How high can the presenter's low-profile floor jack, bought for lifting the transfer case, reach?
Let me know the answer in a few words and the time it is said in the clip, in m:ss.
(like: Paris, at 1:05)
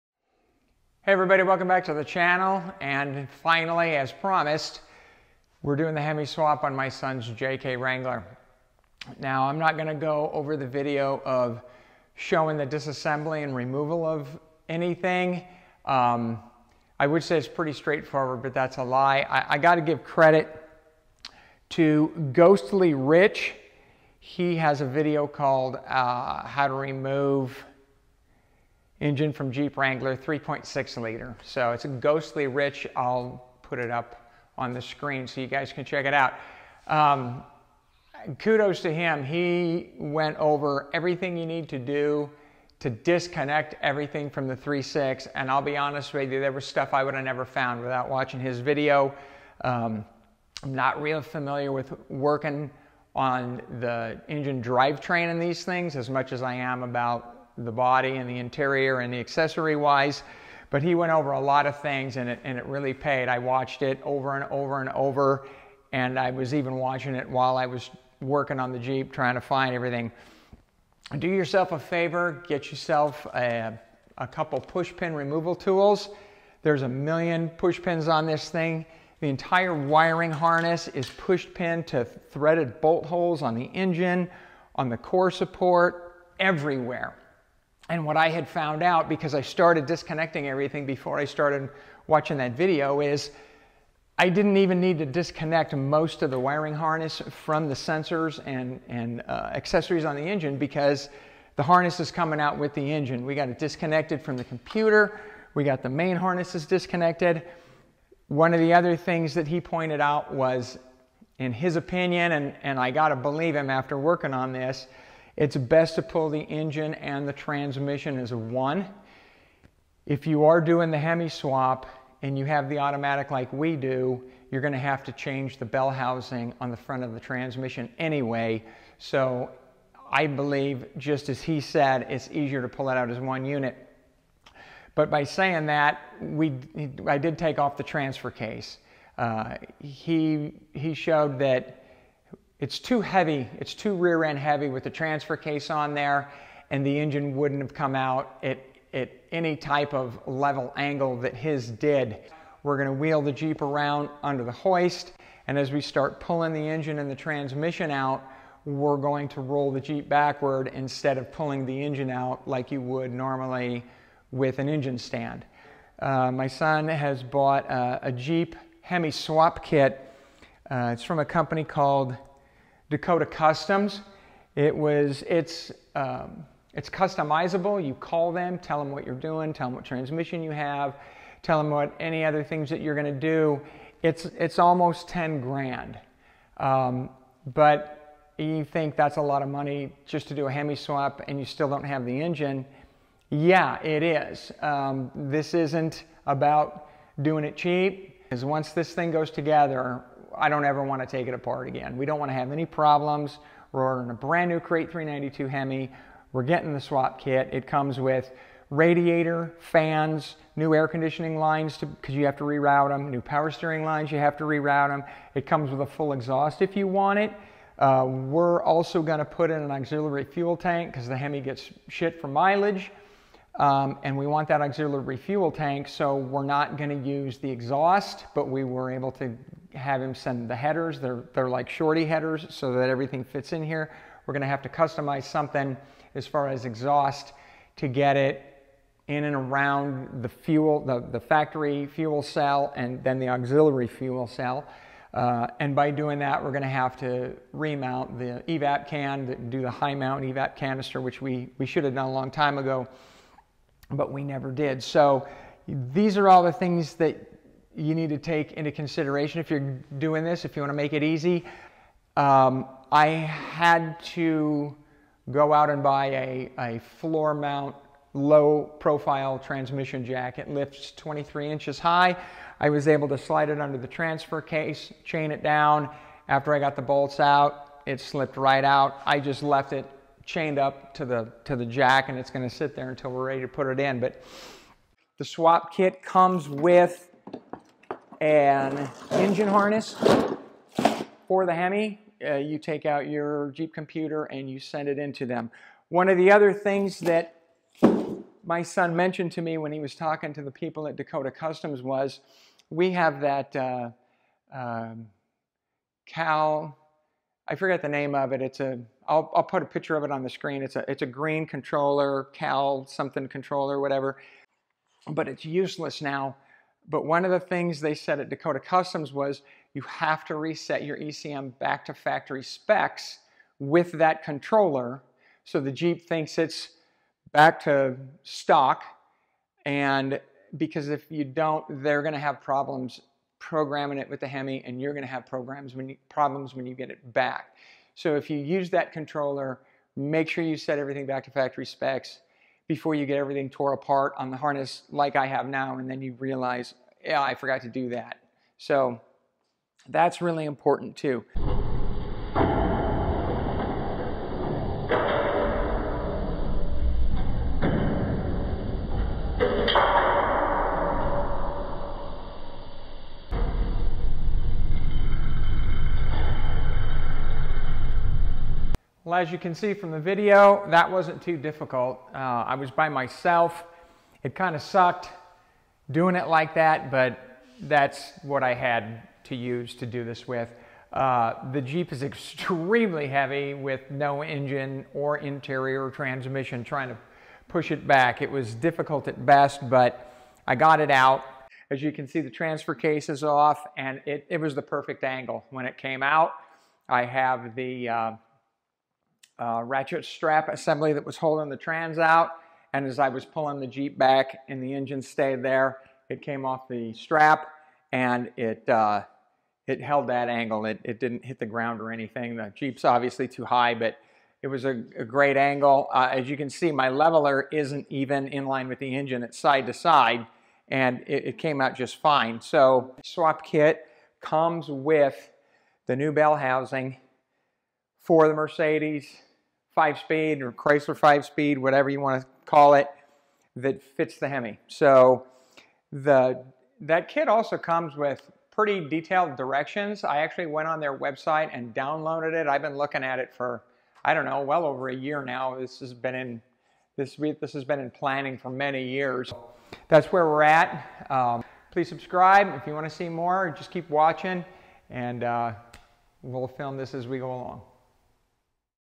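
23 inches, at 4:30.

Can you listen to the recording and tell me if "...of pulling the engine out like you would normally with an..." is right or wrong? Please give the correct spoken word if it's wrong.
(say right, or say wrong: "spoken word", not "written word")
right.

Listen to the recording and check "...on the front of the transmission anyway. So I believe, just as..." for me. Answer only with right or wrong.
right.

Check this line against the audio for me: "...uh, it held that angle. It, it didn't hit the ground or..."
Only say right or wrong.
right.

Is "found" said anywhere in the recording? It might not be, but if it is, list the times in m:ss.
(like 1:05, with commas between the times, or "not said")
0:47, 1:28.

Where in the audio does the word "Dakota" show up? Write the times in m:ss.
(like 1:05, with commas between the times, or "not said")
2:52, 5:00, 5:18.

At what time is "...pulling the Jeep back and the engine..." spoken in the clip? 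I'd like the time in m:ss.
6:43.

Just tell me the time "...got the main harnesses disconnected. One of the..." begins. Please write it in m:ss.
1:45.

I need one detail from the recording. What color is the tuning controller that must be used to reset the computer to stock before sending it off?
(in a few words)
green.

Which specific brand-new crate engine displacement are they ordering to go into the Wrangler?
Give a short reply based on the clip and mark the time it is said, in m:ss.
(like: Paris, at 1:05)
392, at 3:24.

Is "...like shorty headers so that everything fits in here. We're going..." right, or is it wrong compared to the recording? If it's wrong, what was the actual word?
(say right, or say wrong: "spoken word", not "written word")
right.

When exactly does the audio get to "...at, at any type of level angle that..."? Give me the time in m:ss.
2:28.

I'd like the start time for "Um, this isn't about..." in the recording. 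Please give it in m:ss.
3:14.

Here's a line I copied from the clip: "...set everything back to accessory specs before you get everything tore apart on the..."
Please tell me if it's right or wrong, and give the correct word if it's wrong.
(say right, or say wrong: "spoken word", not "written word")
wrong: "factory", not "accessory".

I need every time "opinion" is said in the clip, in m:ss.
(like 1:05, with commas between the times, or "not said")
1:51.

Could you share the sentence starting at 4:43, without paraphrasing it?
But the swap kit comes with an engine harness for the Hemi.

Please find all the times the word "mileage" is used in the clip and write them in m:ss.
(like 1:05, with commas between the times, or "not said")
3:42.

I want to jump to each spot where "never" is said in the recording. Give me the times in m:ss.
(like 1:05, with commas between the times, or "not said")
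0:47, 4:14.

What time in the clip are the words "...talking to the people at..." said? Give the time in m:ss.
4:59.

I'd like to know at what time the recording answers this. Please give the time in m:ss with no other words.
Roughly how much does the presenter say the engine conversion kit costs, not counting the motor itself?
3:04.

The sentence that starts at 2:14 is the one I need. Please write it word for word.
But by saying that, we, I did take off the transfer case.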